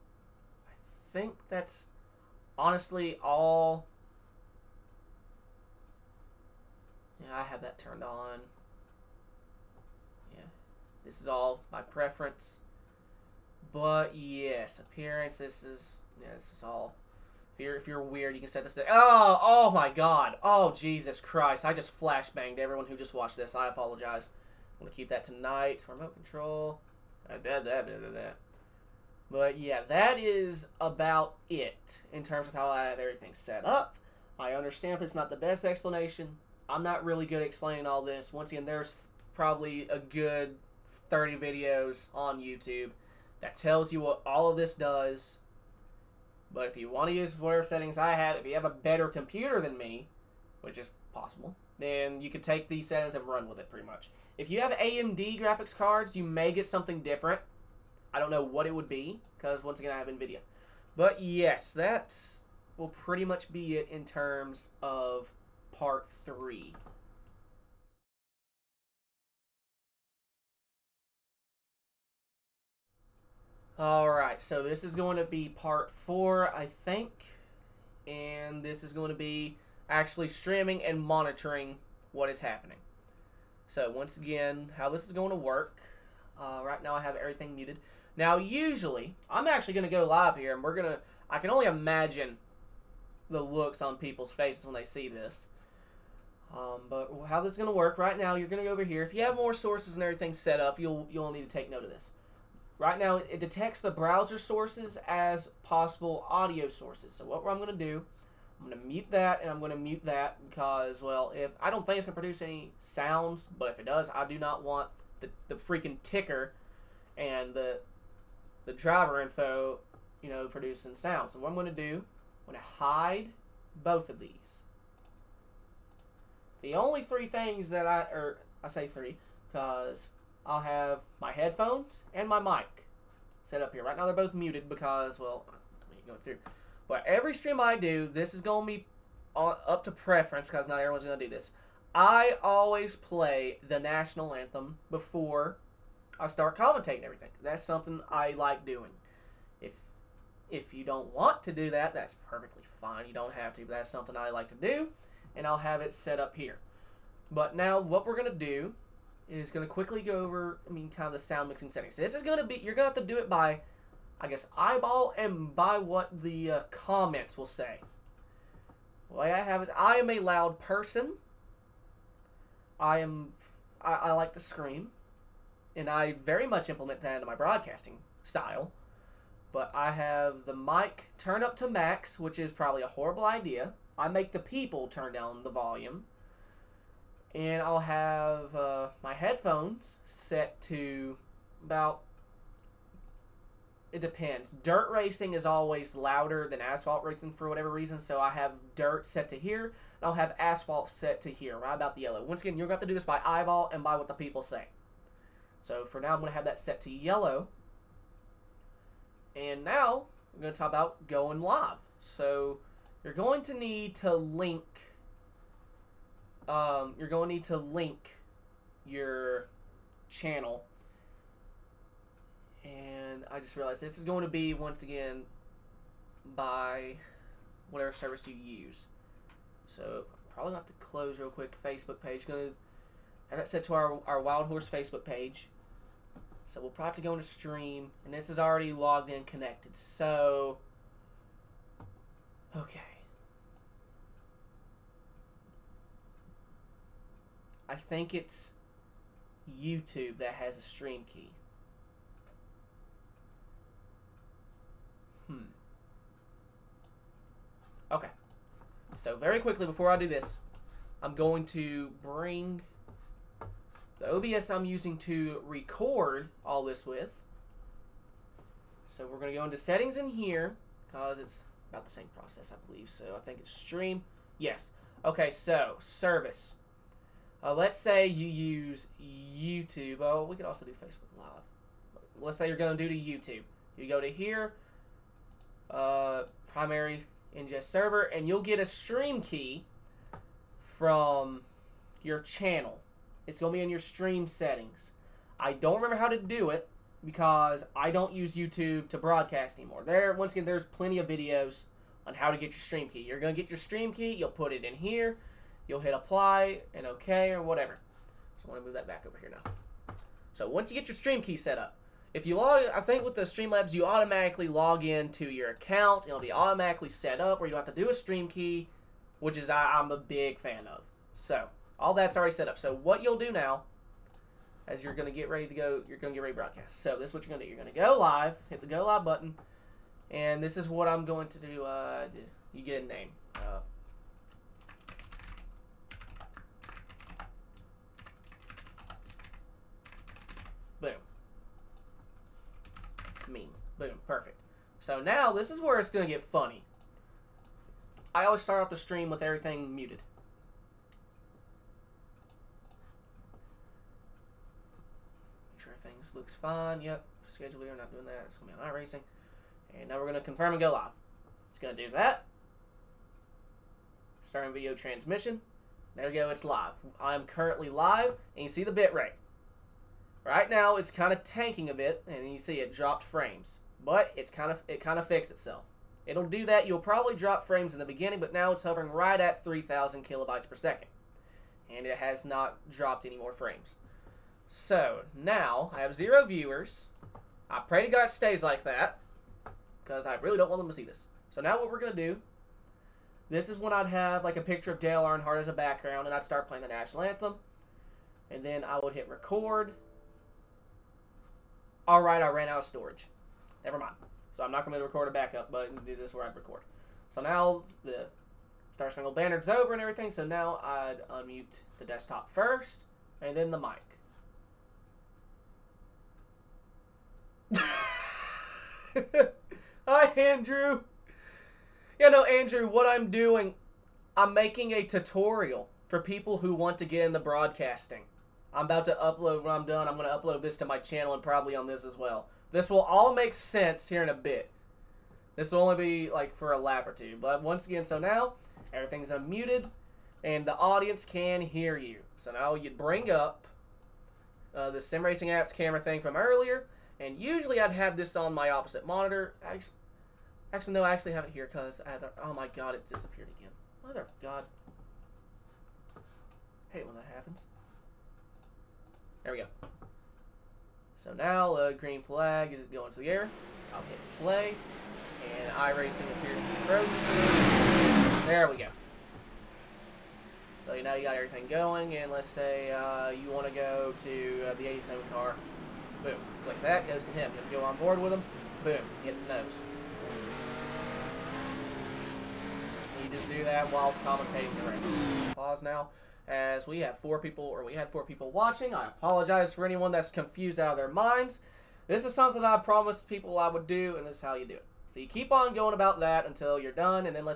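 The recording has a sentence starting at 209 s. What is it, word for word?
And now, I'm going to talk about going live.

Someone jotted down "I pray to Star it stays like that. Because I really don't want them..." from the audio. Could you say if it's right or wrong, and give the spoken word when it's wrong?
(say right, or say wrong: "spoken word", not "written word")
wrong: "God", not "Star".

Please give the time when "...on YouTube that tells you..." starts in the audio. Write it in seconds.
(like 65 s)
42 s.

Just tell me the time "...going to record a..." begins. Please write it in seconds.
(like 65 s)
404 s.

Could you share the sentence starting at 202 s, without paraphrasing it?
Once again, you're going to have to do this by eyeball and by what the people say.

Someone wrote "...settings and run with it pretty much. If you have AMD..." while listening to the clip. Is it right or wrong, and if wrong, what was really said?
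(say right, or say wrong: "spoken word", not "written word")
right.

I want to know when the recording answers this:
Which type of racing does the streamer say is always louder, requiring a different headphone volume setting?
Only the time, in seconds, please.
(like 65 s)
194 s.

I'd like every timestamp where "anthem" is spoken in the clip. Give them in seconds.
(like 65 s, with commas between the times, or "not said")
144 s, 397 s.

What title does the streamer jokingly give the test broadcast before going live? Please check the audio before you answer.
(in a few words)
meme.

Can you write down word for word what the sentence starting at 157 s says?
But now what we're going to do is going to quickly go over, I mean, kind of the sound mixing settings.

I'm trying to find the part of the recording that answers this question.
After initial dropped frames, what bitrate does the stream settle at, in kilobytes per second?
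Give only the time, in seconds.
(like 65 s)
379 s.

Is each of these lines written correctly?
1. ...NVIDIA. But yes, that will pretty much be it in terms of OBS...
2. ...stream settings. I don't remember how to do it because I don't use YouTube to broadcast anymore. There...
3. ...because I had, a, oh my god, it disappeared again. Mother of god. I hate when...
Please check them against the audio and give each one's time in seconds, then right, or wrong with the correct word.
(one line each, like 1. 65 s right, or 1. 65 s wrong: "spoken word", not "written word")
1. 60 s wrong: "Part", not "OBS"
2. 293 s right
3. 451 s right.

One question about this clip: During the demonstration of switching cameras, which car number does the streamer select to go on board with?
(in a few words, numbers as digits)
87.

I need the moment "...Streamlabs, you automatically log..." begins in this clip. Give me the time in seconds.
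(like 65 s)
313 s.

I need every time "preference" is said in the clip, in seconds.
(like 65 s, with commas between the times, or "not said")
11 s, 139 s.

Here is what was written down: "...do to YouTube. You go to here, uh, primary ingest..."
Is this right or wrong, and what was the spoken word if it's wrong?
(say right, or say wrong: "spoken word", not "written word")
right.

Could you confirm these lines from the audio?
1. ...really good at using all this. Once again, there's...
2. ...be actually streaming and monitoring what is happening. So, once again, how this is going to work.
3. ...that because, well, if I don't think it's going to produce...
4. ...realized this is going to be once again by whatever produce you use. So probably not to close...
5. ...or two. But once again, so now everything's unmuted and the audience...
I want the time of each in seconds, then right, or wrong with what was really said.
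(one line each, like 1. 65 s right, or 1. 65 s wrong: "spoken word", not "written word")
1. 37 s wrong: "explaining", not "using"
2. 79 s right
3. 110 s right
4. 223 s wrong: "service", not "produce"
5. 436 s right.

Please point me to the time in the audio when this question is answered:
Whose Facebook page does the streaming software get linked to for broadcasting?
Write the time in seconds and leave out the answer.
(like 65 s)
234 s.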